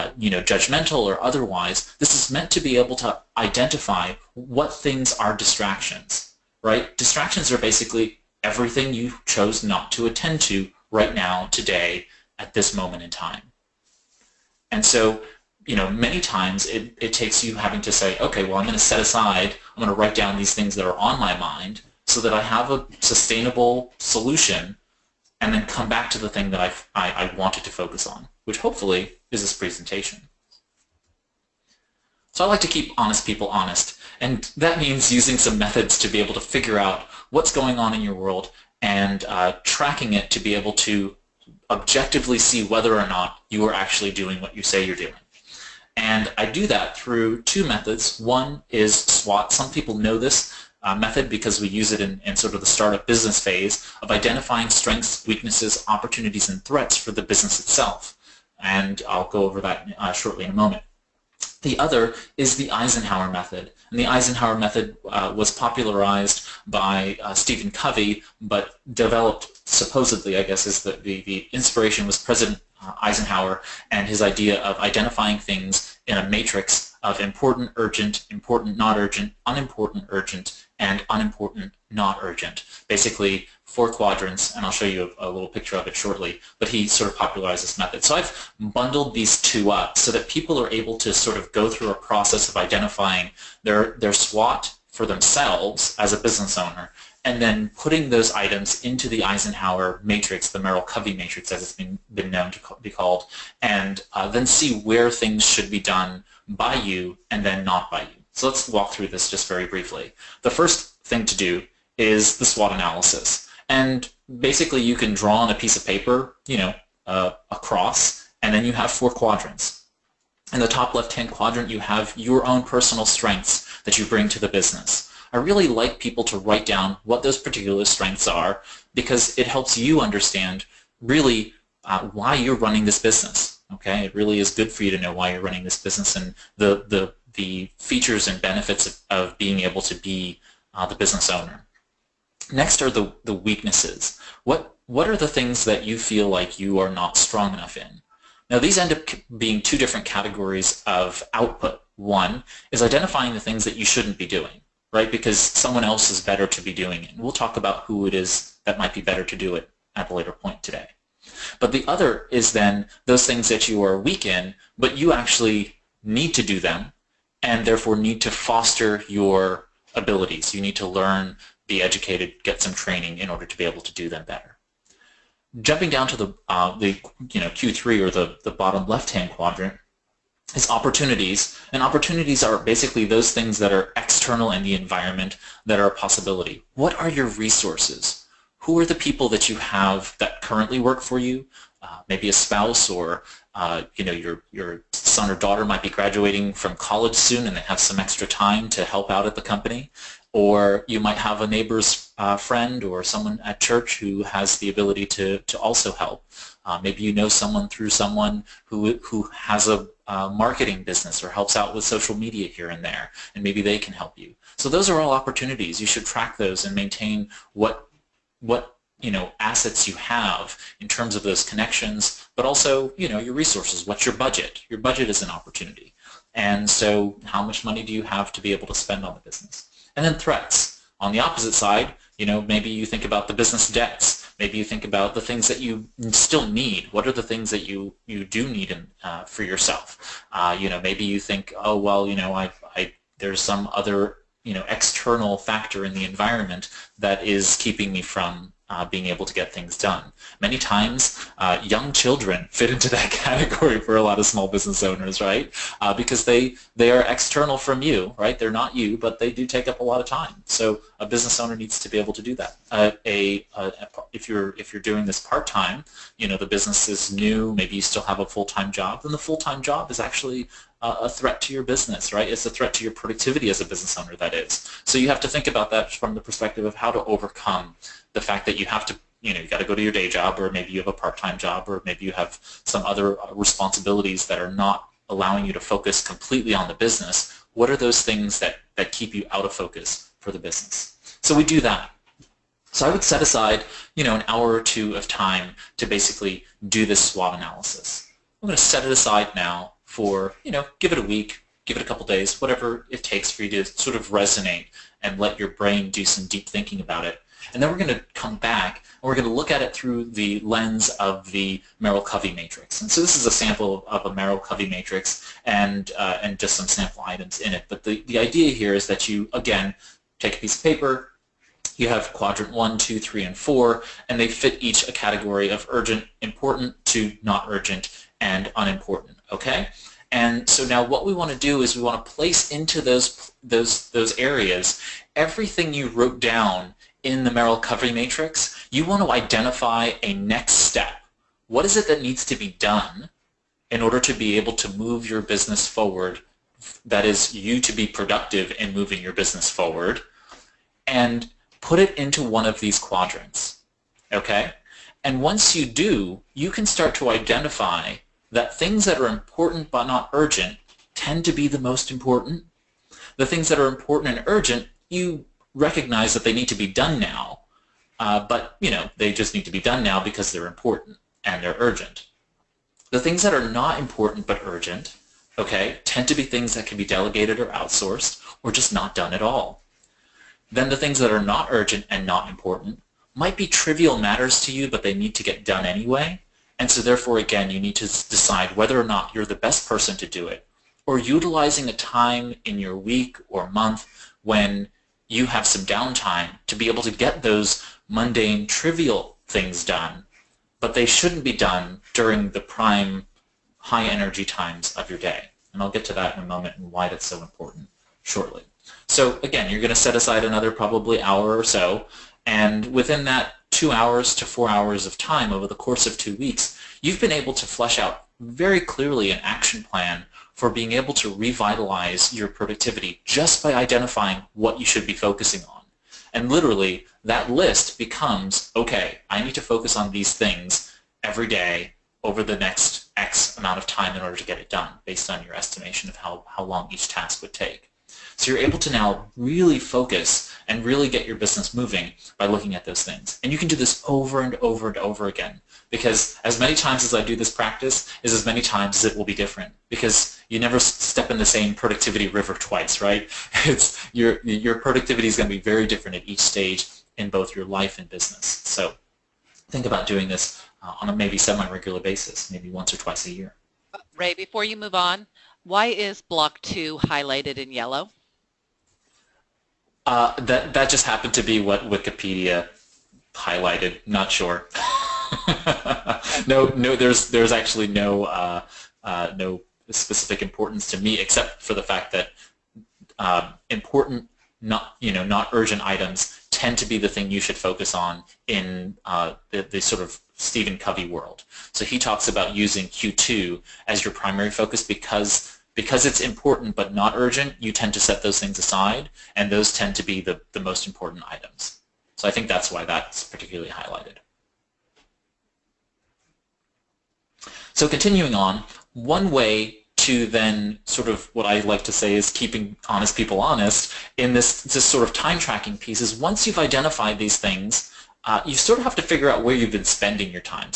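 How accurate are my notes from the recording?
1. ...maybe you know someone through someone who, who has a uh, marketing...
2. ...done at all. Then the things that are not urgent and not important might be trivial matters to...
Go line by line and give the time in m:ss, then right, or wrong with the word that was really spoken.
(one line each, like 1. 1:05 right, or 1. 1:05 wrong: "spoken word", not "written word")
1. 3:26 right
2. 6:18 right.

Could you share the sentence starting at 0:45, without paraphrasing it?
And I do that through two methods.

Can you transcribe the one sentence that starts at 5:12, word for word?
And so this is a sample of a Merrill Covey matrix and, uh, and just some sample items in it.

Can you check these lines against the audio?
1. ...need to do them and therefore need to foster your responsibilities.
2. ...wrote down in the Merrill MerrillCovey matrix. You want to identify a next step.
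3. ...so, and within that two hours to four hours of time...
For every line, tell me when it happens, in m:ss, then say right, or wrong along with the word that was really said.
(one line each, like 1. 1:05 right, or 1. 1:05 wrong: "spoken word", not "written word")
1. 2:46 wrong: "abilities", not "responsibilities"
2. 5:35 wrong: "Covey", not "MerrillCovey"
3. 6:51 right.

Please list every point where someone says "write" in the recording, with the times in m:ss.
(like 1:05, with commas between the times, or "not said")
0:19, 2:06.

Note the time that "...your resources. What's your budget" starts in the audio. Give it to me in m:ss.
3:43.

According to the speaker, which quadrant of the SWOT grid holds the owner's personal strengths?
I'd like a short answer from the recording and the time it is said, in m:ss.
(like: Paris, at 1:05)
top left-hand quadrant, at 2:00.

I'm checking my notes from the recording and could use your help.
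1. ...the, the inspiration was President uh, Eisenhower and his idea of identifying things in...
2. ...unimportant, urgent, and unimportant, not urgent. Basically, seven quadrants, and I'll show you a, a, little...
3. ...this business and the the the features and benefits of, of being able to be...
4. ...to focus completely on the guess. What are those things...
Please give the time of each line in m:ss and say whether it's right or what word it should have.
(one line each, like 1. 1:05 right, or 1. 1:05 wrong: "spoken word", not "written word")
1. 1:11 right
2. 1:19 wrong: "four", not "seven"
3. 2:15 right
4. 4:45 wrong: "business", not "guess".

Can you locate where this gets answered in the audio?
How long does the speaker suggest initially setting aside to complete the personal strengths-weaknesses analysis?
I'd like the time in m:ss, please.
4:54.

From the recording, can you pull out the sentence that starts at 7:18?
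So you're able to now really focus and really get your business moving by looking at those things.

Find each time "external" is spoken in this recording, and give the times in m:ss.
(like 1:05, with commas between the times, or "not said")
3:03, 4:04, 4:17.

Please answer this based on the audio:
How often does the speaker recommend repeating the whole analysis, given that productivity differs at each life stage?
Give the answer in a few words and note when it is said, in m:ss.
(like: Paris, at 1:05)
once or twice a year, at 7:42.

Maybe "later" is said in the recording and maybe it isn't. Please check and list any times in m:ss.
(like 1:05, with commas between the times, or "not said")
2:40.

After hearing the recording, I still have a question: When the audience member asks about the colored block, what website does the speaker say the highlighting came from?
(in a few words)
Wikipedia.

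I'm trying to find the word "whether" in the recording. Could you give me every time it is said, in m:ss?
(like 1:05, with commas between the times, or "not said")
0:42, 6:28.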